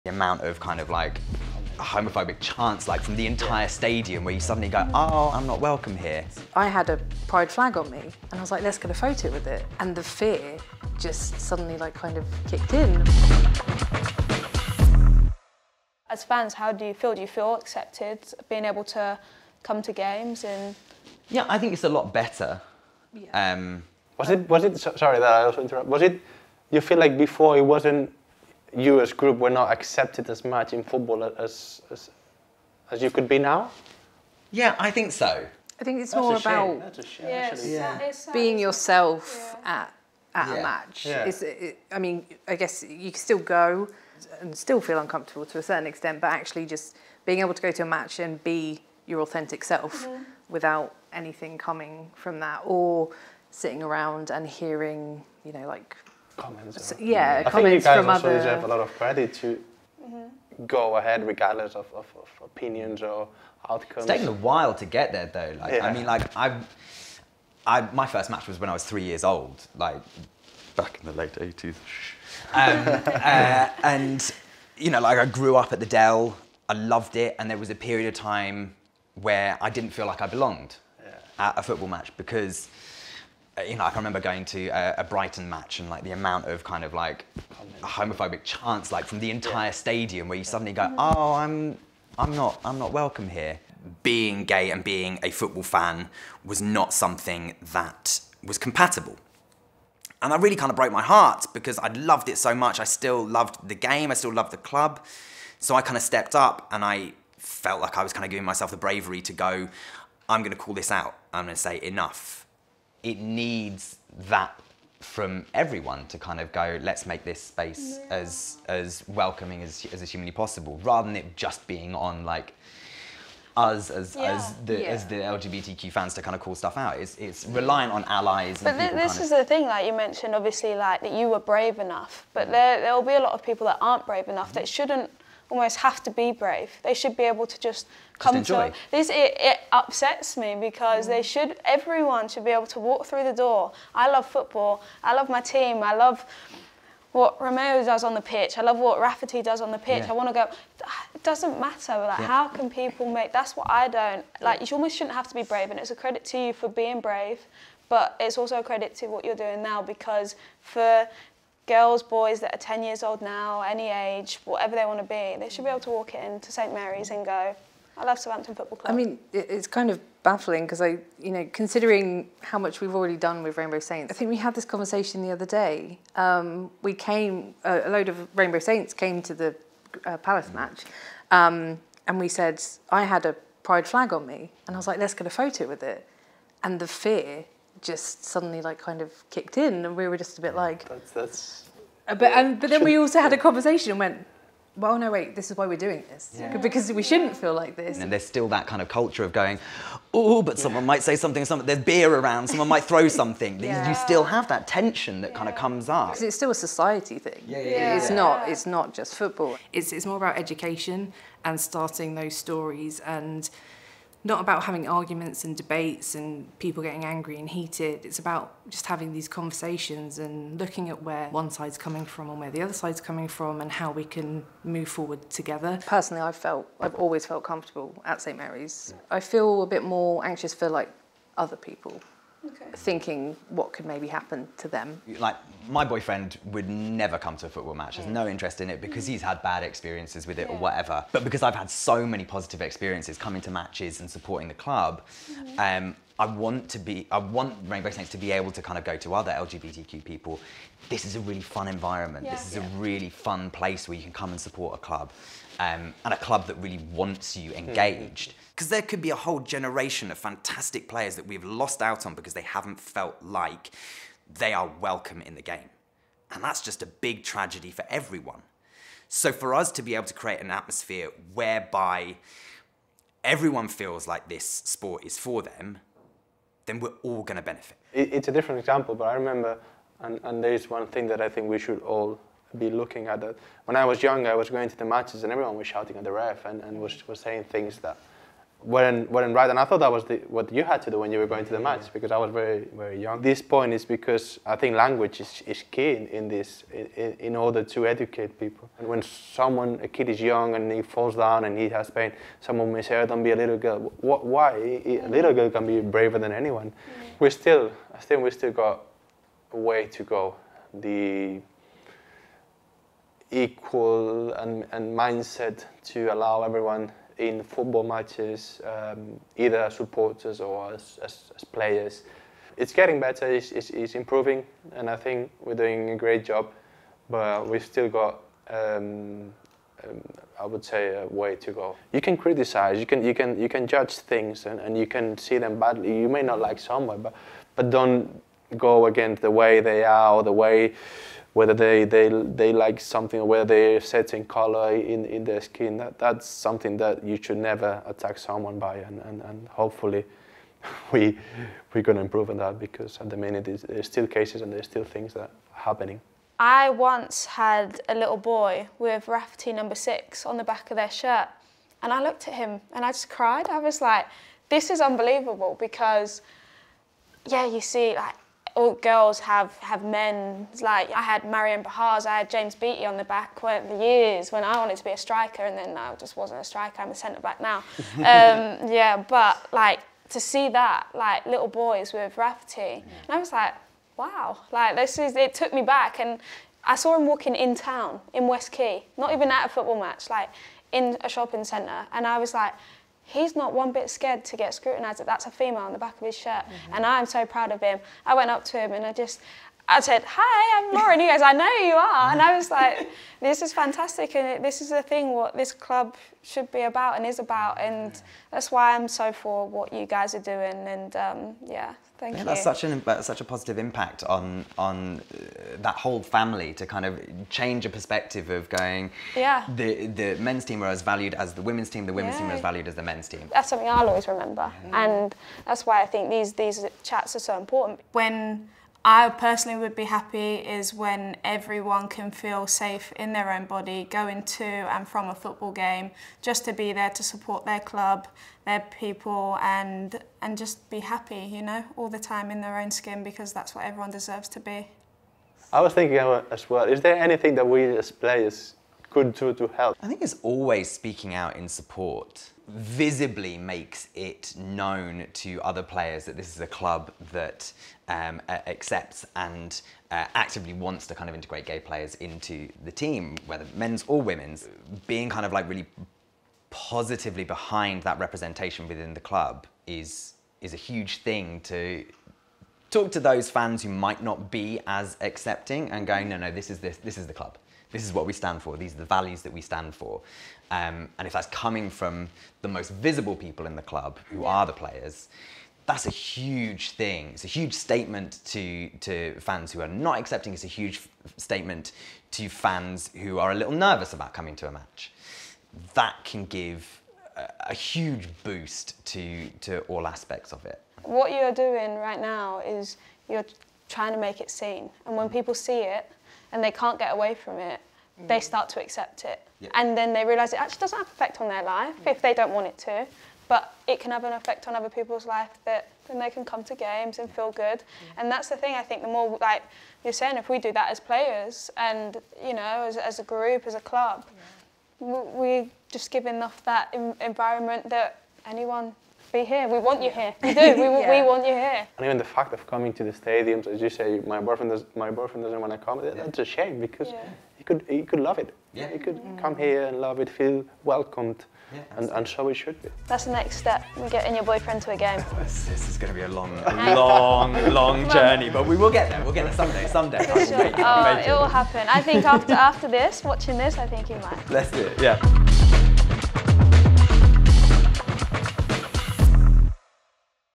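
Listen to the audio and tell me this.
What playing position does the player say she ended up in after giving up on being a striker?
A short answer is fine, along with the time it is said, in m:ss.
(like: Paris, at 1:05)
Centre back, at 6:16.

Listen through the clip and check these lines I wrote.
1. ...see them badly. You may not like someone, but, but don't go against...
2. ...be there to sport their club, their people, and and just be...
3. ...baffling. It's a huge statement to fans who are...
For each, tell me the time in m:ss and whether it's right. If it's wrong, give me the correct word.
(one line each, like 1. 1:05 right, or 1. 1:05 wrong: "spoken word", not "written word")
1. 5:35 right
2. 7:16 wrong: "support", not "sport"
3. 8:09 wrong: "accepting", not "baffling".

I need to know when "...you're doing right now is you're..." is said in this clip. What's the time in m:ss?
8:21.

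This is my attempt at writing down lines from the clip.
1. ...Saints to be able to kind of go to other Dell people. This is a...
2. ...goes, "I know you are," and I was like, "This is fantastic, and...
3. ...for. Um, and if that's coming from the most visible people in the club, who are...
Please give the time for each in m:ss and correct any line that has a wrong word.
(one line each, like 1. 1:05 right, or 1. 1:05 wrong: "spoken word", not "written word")
1. 4:07 wrong: "LGBTQ", not "Dell"
2. 6:41 right
3. 7:59 right.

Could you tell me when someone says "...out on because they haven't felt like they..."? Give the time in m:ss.
4:21.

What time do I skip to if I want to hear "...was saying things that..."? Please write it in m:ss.
4:47.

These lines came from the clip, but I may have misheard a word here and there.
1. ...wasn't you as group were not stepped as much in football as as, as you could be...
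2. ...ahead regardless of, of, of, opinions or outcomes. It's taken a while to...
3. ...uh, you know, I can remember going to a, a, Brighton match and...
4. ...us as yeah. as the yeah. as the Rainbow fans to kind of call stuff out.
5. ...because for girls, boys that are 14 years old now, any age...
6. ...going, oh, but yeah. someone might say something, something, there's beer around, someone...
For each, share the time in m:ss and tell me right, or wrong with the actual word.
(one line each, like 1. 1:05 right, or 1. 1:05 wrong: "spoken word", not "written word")
1. 0:27 wrong: "accepted", not "stepped"
2. 1:00 right
3. 1:23 right
4. 2:03 wrong: "LGBTQ", not "Rainbow"
5. 2:39 wrong: "10", not "14"
6. 3:19 right.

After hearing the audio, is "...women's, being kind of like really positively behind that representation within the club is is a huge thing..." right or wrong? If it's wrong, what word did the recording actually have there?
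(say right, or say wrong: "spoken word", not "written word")
right.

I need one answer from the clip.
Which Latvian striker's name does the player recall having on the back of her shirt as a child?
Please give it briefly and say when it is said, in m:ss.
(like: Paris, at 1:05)
Marian Pahars, at 6:11.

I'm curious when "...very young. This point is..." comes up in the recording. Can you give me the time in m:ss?
4:52.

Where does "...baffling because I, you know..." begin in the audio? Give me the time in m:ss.
2:50.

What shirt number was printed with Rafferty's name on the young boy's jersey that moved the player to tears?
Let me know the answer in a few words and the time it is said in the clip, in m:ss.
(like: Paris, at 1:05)
6, at 5:59.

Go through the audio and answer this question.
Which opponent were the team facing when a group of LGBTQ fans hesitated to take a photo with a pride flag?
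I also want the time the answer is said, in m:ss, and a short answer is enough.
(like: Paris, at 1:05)
Palace, at 3:00.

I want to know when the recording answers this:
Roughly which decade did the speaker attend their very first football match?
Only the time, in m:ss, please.
1:11.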